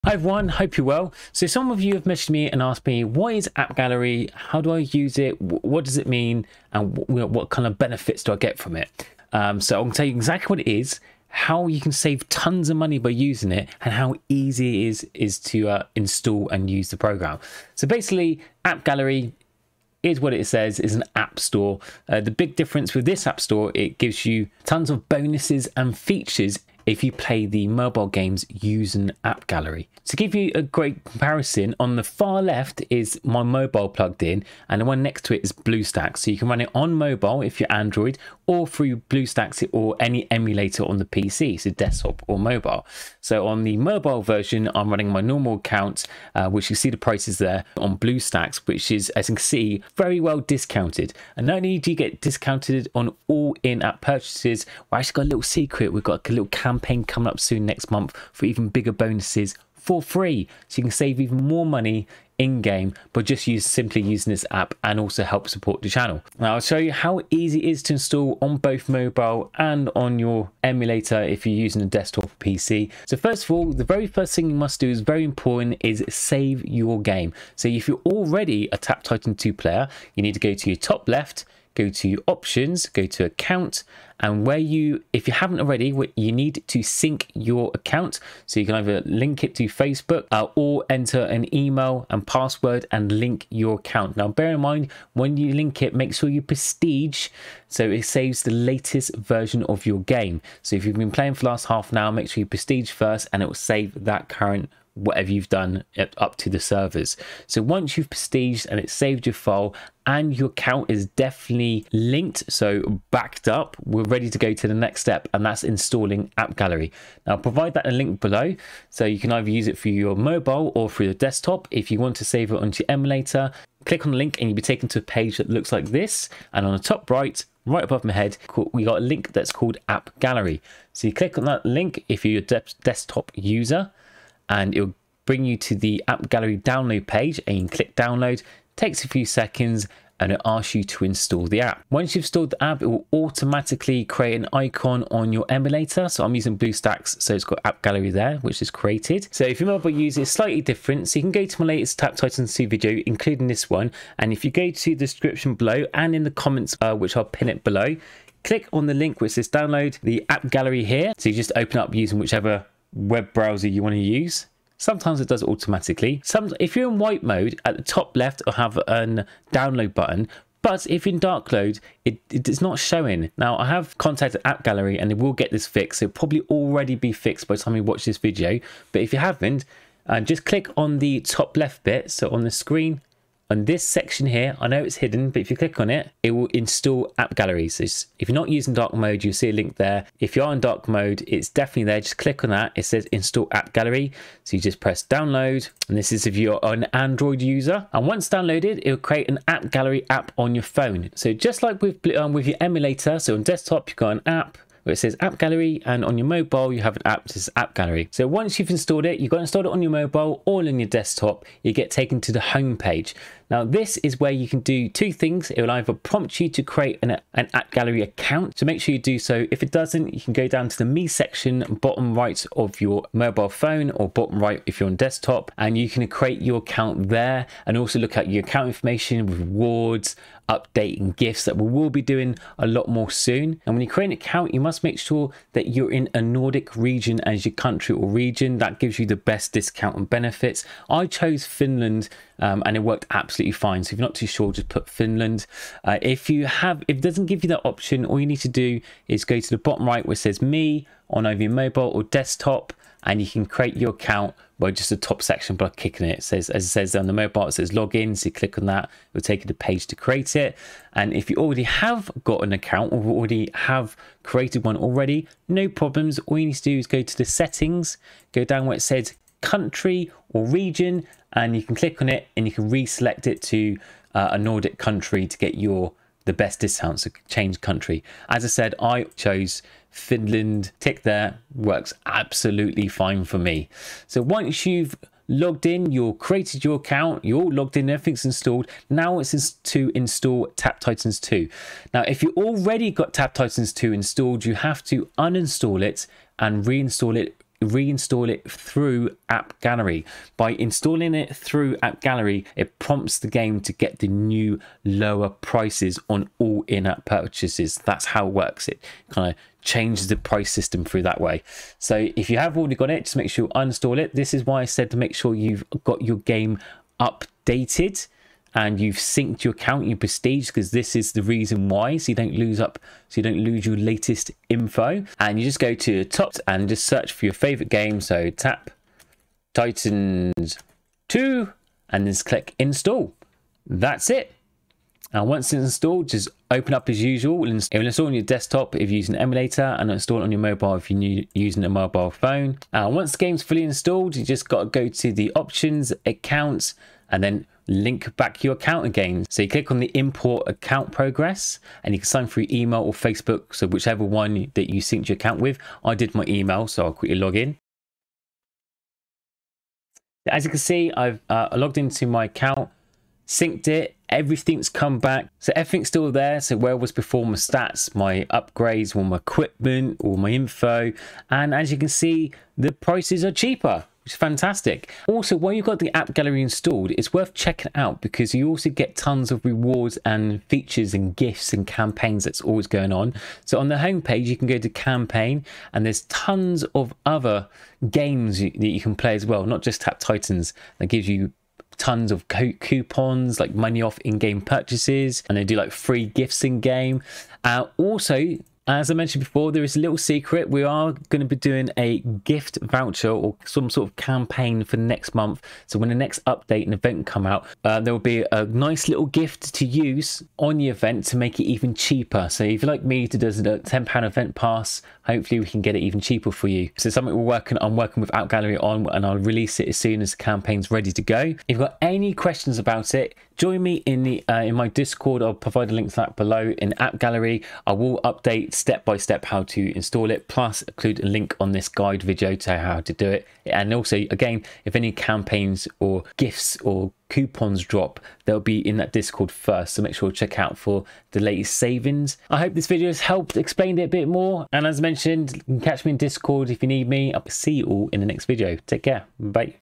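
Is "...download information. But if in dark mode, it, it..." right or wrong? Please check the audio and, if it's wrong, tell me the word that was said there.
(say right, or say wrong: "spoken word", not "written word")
wrong: "button", not "information".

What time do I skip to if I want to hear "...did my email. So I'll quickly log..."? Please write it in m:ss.
5:55.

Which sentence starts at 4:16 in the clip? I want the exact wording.
it says, as it says on the mobile, it says login.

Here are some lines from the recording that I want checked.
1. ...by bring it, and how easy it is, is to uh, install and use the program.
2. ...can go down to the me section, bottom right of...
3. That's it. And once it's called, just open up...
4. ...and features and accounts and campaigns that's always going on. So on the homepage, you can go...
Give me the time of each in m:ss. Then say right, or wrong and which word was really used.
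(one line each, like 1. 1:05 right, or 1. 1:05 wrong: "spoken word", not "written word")
1. 0:12 wrong: "using", not "bring"
2. 3:40 right
3. 5:33 wrong: "installed", not "called"
4. 6:20 wrong: "gifts", not "accounts".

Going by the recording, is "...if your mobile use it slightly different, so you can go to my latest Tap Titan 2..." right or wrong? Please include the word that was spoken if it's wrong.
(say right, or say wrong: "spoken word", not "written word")
right.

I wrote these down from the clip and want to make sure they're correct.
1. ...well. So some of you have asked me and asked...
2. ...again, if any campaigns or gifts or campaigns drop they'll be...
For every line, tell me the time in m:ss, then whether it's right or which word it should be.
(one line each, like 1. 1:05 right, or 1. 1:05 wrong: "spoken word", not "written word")
1. 0:00 wrong: "messaged", not "asked"
2. 7:14 wrong: "coupons", not "campaigns".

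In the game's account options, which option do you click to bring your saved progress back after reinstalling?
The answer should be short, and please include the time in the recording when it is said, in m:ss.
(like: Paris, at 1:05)
Import account progress, at 5:49.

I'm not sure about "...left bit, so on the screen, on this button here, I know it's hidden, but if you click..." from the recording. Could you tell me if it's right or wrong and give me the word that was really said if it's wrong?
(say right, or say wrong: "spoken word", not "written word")
wrong: "section", not "button".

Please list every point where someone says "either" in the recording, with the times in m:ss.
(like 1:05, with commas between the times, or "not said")
1:28, 1:59, 3:35, 4:11.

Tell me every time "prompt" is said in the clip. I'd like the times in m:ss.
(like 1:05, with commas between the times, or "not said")
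3:35, 5:02.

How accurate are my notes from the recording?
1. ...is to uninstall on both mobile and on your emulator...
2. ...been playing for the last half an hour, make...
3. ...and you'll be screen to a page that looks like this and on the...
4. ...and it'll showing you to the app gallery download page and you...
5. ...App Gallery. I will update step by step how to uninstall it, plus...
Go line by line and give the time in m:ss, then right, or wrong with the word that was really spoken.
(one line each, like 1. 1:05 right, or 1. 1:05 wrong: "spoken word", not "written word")
1. 1:07 wrong: "install", not "uninstall"
2. 1:40 right
3. 2:04 wrong: "taken", not "screen"
4. 2:14 wrong: "bring", not "showing"
5. 7:06 wrong: "install", not "uninstall".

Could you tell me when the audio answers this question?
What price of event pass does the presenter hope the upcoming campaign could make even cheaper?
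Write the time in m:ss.
6:53.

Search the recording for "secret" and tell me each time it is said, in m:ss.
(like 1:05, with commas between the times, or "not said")
0:55, 6:39.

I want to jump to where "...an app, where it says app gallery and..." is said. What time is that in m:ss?
3:24.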